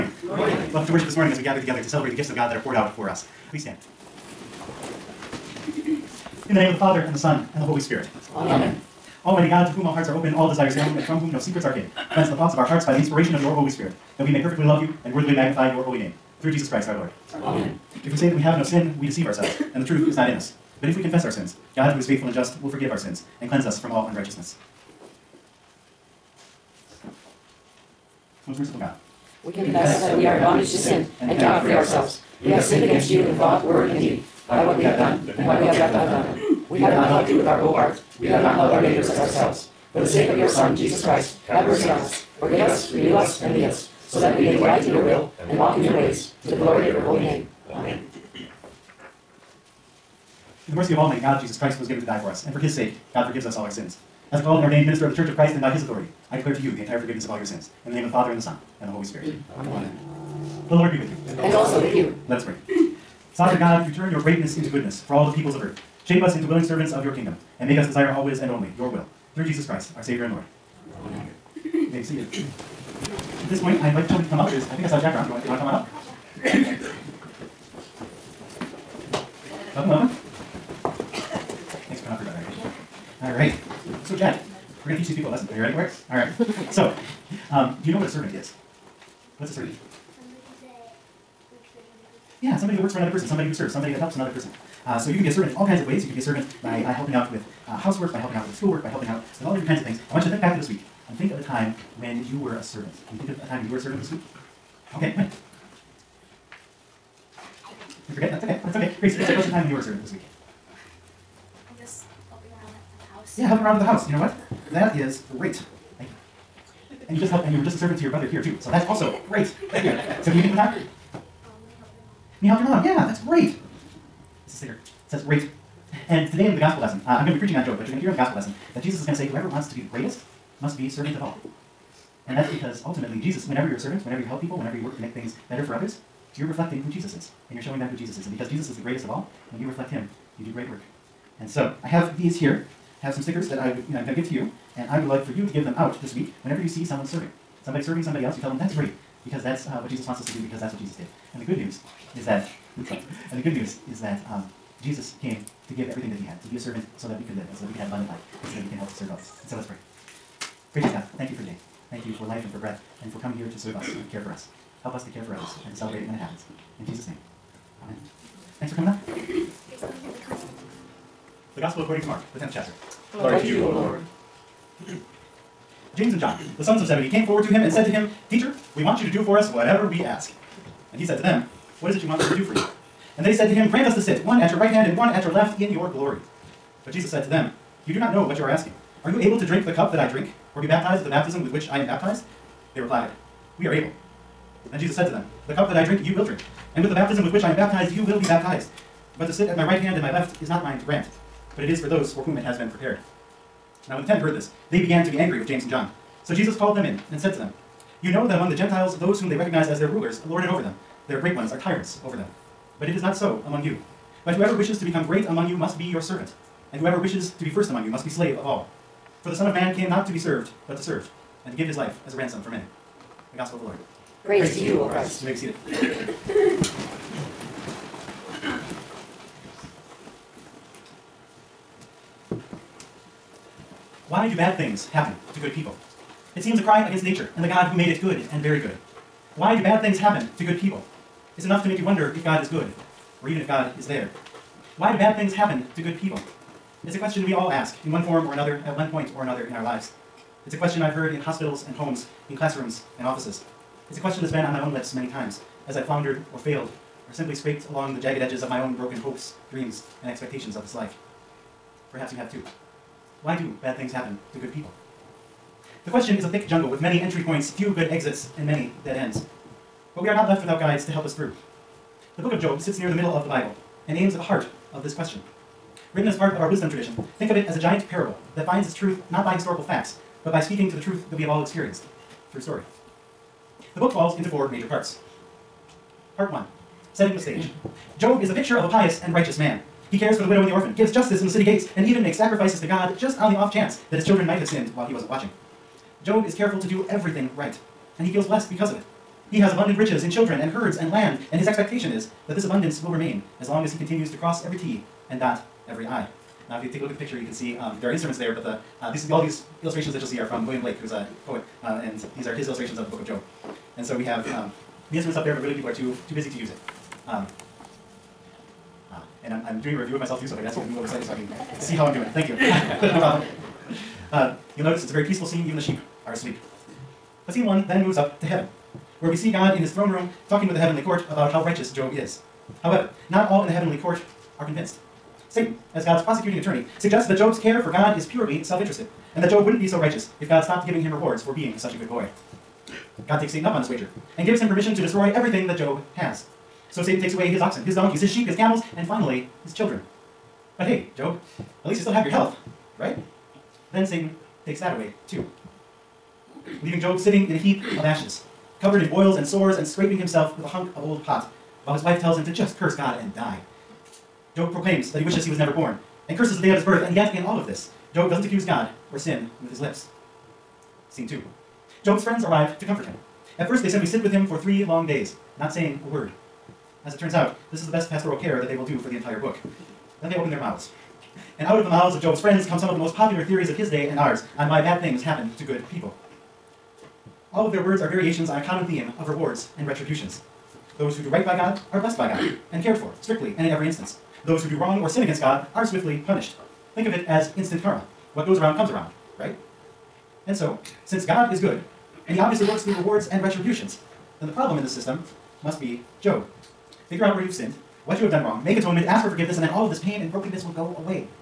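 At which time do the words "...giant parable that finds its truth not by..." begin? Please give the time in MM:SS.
04:37.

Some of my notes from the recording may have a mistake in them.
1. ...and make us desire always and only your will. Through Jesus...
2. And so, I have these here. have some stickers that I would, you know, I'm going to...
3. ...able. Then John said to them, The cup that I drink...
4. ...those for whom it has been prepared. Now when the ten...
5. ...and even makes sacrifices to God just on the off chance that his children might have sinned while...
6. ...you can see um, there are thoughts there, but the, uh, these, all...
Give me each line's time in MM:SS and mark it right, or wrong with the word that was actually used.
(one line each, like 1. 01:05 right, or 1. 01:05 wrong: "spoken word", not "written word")
1. 01:07 right
2. 02:21 right
3. 03:13 wrong: "Jesus", not "John"
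4. 03:21 right
5. 04:51 right
6. 05:07 wrong: "instruments", not "thoughts".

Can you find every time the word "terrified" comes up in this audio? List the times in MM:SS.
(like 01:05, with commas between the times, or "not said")
not said.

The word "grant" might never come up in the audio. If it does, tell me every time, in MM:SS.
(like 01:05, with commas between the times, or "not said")
03:03, 03:20.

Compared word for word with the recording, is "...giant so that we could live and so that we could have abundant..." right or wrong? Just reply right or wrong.
wrong.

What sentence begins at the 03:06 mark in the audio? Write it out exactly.
But Jesus said to them, You do not know what you are asking.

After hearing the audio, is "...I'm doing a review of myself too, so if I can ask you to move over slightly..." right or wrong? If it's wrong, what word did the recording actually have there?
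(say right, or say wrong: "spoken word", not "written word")
right.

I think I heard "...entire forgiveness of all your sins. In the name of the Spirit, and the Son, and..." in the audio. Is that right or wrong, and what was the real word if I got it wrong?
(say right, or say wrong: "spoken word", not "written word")
wrong: "Father", not "Spirit".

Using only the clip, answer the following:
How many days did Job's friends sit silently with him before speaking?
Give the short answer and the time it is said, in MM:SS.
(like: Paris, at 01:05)
3, at 06:14.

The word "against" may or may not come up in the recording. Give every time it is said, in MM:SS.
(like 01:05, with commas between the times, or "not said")
00:32, 03:56, 06:35.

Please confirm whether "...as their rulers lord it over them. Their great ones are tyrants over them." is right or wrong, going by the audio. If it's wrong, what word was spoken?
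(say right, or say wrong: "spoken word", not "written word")
right.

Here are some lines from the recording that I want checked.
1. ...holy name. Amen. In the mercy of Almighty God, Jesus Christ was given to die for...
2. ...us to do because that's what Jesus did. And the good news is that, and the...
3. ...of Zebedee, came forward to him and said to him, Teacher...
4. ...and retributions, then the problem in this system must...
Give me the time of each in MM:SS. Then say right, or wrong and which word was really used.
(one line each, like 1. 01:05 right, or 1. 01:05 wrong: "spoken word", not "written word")
1. 00:47 right
2. 02:30 right
3. 02:56 right
4. 06:43 right.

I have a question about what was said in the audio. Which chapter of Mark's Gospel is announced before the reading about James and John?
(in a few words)
10th.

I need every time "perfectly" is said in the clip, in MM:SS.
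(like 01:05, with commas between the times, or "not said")
00:14.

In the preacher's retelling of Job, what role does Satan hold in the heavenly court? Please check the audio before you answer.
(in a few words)
Prosecuting attorney.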